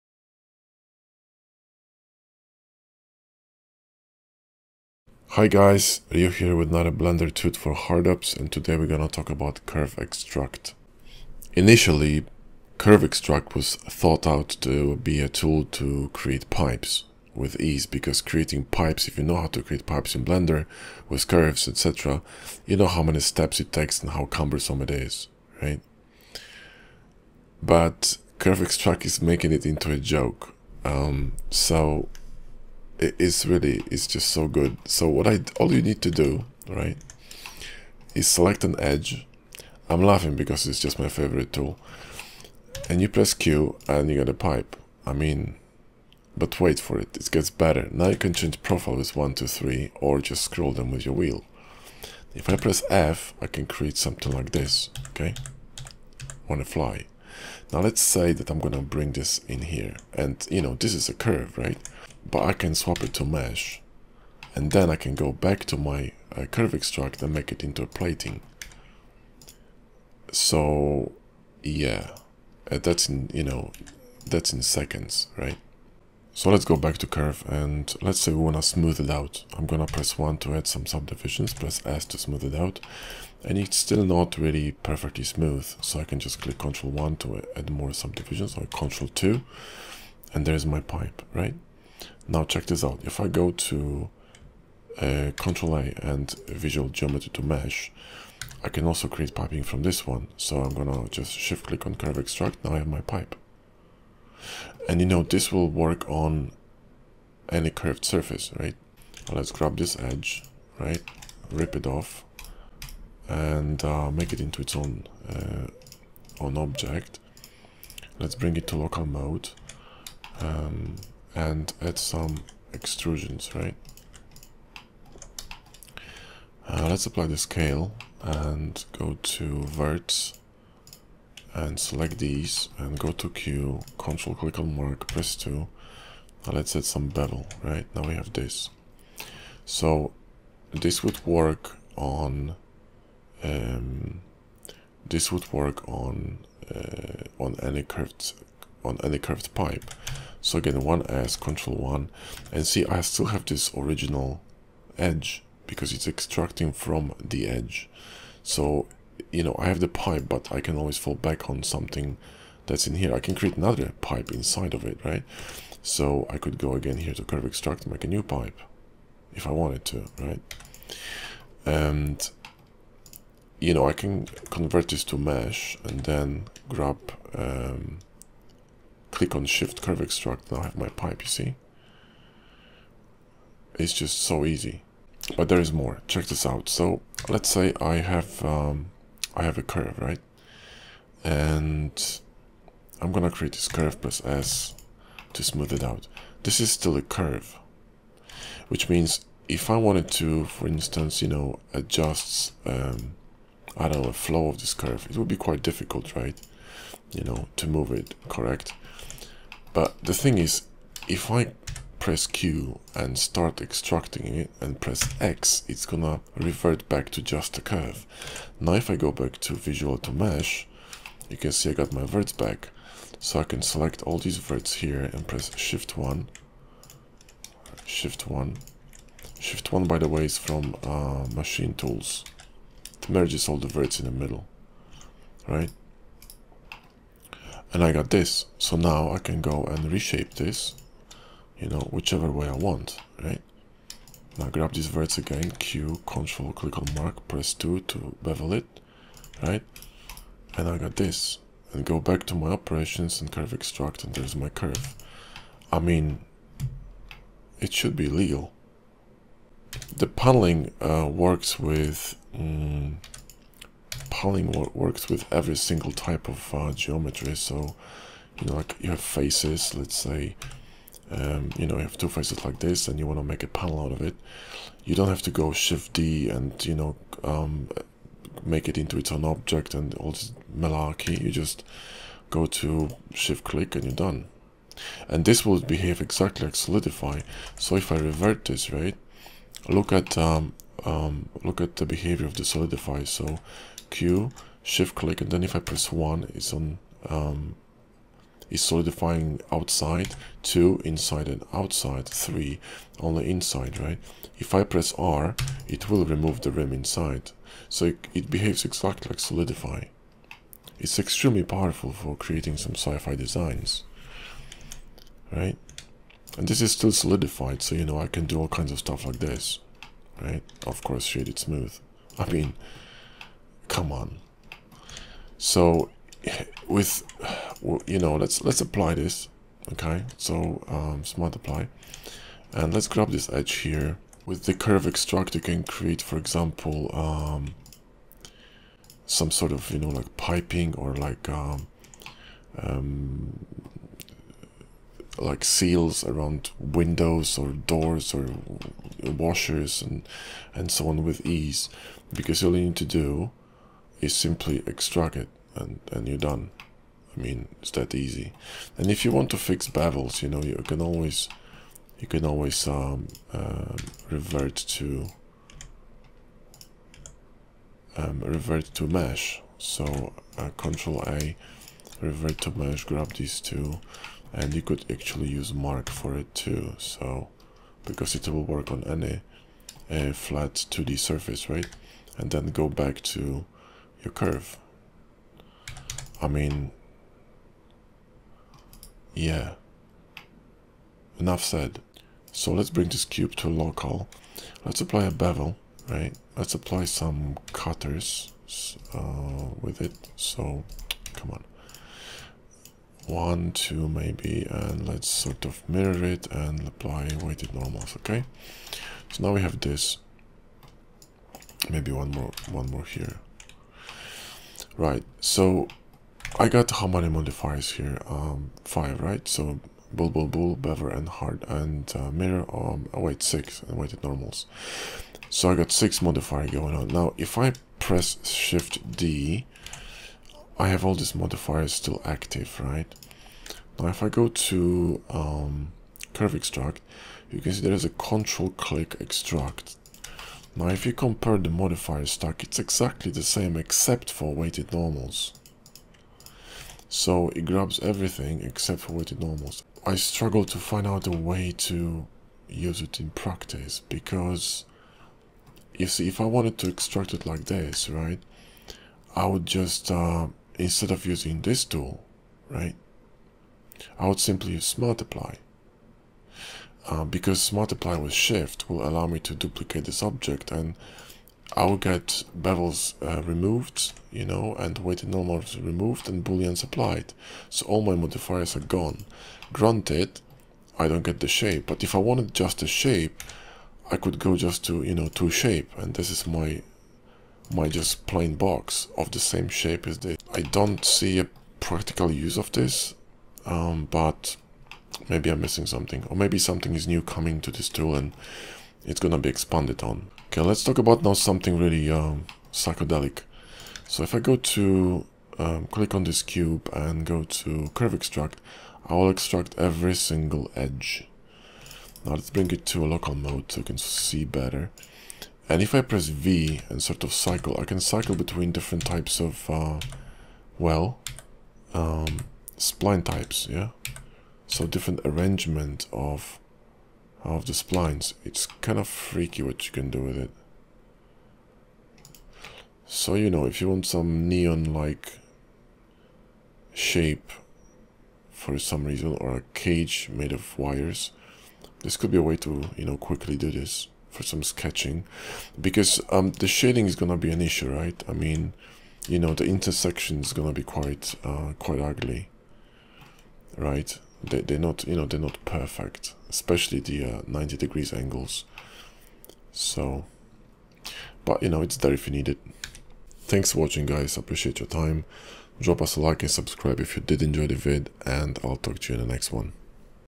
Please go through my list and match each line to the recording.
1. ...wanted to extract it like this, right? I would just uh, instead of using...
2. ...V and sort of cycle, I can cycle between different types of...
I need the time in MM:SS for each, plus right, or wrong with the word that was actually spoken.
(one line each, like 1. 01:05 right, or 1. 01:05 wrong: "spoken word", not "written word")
1. 07:36 right
2. 08:36 right.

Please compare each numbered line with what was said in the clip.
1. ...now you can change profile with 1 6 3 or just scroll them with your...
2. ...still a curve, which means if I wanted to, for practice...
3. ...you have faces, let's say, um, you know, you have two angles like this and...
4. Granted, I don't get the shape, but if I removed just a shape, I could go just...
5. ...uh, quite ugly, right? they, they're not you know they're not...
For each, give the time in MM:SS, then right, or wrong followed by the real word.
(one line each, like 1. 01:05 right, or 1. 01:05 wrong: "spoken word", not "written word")
1. 00:47 wrong: "2", not "6"
2. 03:16 wrong: "instance", not "practice"
3. 04:28 wrong: "faces", not "angles"
4. 07:59 wrong: "wanted", not "removed"
5. 09:11 right.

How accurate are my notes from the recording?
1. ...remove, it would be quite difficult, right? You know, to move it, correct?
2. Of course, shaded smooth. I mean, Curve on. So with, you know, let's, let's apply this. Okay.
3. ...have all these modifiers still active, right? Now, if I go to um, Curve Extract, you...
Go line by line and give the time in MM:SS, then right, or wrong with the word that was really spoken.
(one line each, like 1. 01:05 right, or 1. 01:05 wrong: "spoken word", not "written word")
1. 03:24 wrong: "curve", not "remove"
2. 05:20 wrong: "Come", not "Curve"
3. 07:10 right.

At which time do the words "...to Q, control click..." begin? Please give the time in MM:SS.
02:13.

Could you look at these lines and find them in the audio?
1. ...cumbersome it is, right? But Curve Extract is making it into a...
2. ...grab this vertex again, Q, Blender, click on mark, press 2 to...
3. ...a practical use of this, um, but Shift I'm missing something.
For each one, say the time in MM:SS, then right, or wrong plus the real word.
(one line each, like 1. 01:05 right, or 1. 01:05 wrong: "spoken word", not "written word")
1. 00:24 right
2. 04:04 wrong: "Control", not "Blender"
3. 08:11 wrong: "Maybe", not "Shift".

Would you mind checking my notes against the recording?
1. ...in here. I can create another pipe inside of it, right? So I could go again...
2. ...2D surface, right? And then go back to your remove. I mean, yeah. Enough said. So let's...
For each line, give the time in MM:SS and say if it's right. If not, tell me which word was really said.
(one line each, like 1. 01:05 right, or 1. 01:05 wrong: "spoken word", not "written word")
1. 02:42 right
2. 06:20 wrong: "curve", not "remove".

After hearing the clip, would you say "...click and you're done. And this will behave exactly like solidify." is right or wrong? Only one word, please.
right.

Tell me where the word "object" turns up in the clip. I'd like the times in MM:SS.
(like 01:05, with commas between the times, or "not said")
01:56, 04:39, 07:50.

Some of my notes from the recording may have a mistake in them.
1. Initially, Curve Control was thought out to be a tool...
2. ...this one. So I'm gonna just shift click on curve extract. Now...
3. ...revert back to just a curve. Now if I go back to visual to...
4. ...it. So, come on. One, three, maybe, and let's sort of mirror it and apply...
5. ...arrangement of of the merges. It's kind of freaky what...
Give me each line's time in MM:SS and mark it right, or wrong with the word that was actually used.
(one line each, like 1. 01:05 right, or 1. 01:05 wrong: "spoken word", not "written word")
1. 00:11 wrong: "Extract", not "Control"
2. 01:39 right
3. 03:36 right
4. 06:39 wrong: "two", not "three"
5. 08:45 wrong: "splines", not "merges".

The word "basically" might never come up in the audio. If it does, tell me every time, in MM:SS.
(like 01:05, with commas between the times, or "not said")
not said.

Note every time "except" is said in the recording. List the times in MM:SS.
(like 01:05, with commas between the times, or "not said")
07:23, 07:28.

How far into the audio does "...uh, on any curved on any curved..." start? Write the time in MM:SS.
02:26.